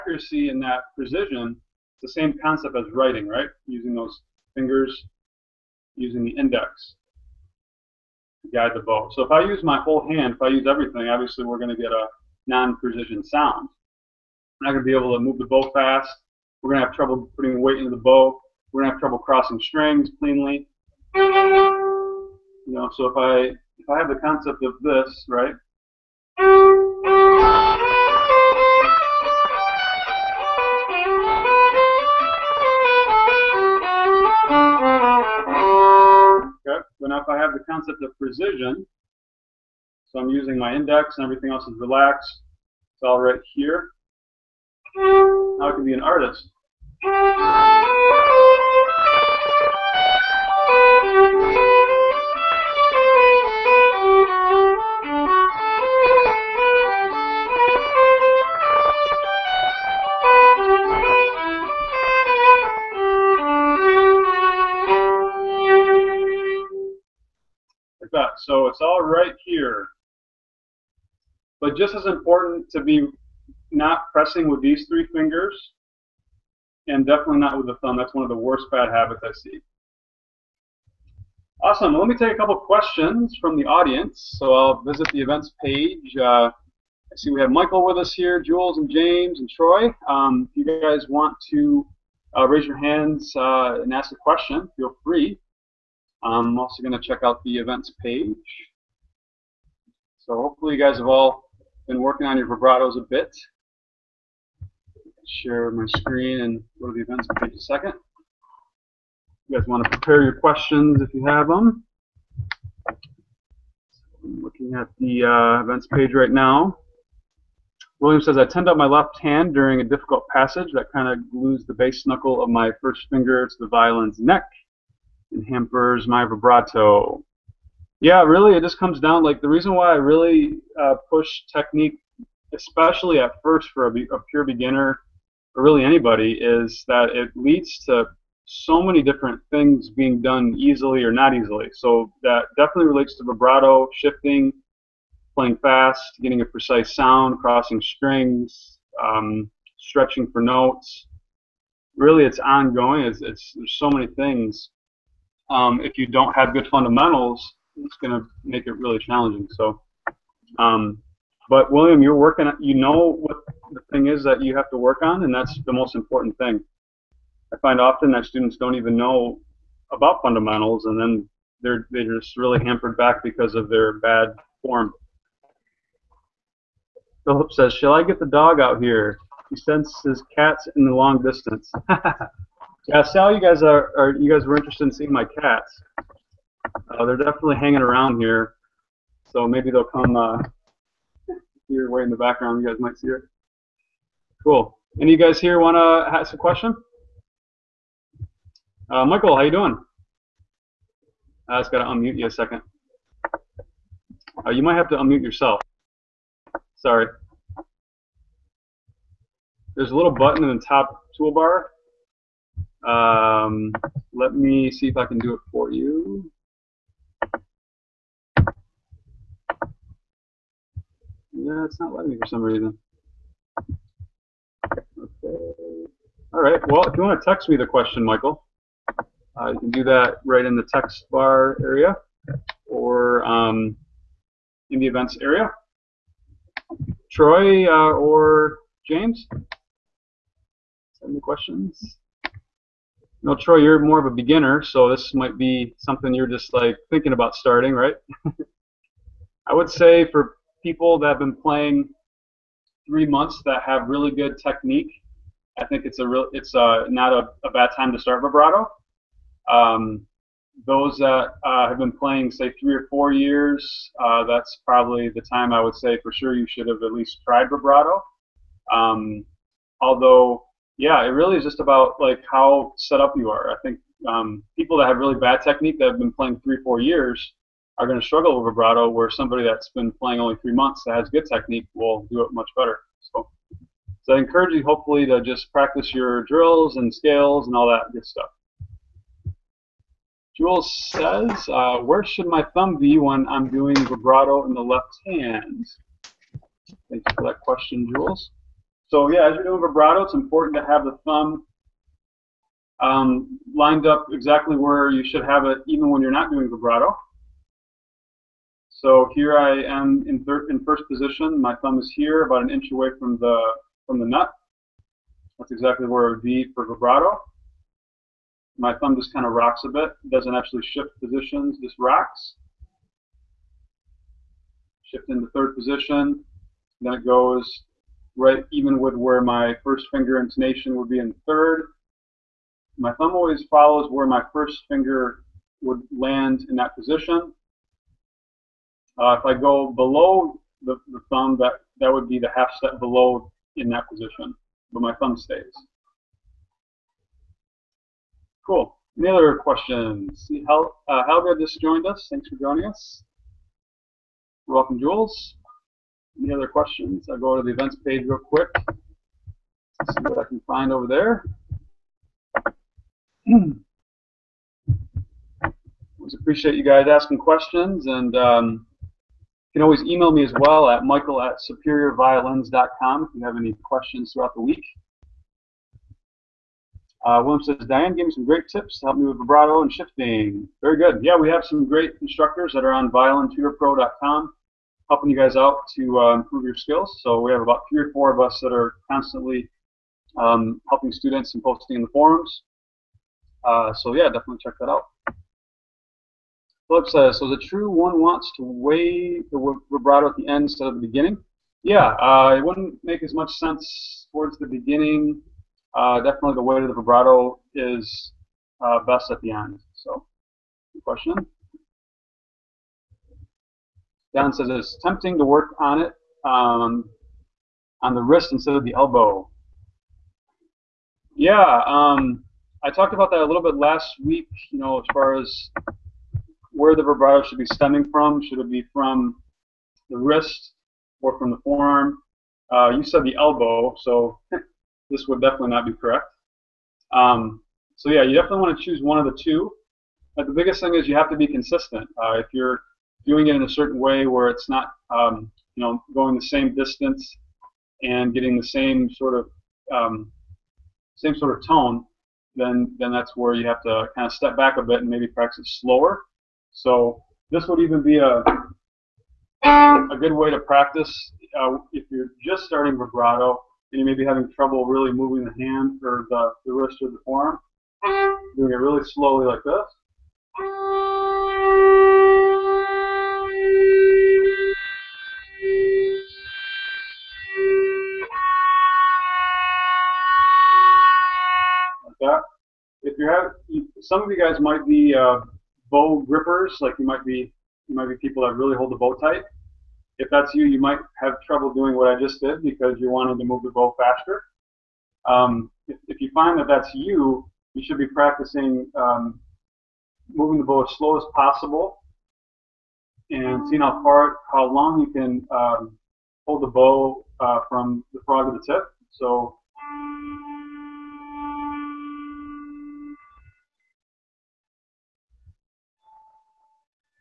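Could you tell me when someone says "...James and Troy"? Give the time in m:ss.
1:28.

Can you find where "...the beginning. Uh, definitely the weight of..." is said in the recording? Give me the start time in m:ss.
6:44.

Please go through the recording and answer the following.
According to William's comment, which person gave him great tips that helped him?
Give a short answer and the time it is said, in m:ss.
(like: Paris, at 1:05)
Diane, at 6:17.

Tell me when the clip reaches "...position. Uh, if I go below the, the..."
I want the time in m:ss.
5:36.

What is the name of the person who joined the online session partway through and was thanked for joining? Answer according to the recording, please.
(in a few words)
Helga.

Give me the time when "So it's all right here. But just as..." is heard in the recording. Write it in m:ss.
1:08.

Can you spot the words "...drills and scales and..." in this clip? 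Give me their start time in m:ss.
4:46.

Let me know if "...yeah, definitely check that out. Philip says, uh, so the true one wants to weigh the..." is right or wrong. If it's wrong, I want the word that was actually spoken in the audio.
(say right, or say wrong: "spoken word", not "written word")
right.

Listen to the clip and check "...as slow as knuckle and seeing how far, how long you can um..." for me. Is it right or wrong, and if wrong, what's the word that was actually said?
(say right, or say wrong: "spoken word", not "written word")
wrong: "possible", not "knuckle".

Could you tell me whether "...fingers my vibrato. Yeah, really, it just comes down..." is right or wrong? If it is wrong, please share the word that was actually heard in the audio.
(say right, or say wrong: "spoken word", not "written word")
wrong: "hampers", not "fingers".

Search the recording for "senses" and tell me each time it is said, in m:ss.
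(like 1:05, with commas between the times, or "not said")
2:59, 6:43.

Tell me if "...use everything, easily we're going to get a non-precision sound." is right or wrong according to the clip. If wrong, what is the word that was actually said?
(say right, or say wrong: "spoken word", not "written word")
wrong: "obviously", not "easily".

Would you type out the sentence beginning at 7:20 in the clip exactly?
But the biggest thing is you have to be consistent.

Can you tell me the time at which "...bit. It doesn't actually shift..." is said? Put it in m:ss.
5:19.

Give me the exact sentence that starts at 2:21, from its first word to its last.
So that definitely relates to vibrato, shifting, playing fast, getting a precise sound, crossing strings, um, stretching for notes.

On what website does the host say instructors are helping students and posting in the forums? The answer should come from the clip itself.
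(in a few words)
violintutorpro.com.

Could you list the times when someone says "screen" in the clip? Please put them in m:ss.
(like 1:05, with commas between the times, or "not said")
1:45.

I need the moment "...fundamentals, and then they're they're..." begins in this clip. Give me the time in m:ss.
2:50.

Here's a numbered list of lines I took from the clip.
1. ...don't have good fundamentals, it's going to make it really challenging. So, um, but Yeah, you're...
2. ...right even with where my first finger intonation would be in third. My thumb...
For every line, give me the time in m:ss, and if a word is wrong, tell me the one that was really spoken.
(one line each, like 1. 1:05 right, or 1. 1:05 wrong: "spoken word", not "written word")
1. 2:36 wrong: "William", not "Yeah"
2. 5:28 right.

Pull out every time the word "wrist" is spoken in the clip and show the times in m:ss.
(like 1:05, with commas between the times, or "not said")
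6:58, 7:09, 7:46.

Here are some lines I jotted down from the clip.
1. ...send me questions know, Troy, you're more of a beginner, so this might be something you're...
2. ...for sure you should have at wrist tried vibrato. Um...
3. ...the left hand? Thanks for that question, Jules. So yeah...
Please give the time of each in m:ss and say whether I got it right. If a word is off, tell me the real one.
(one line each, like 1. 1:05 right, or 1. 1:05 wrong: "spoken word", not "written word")
1. 4:00 right
2. 4:26 wrong: "least", not "wrist"
3. 4:54 right.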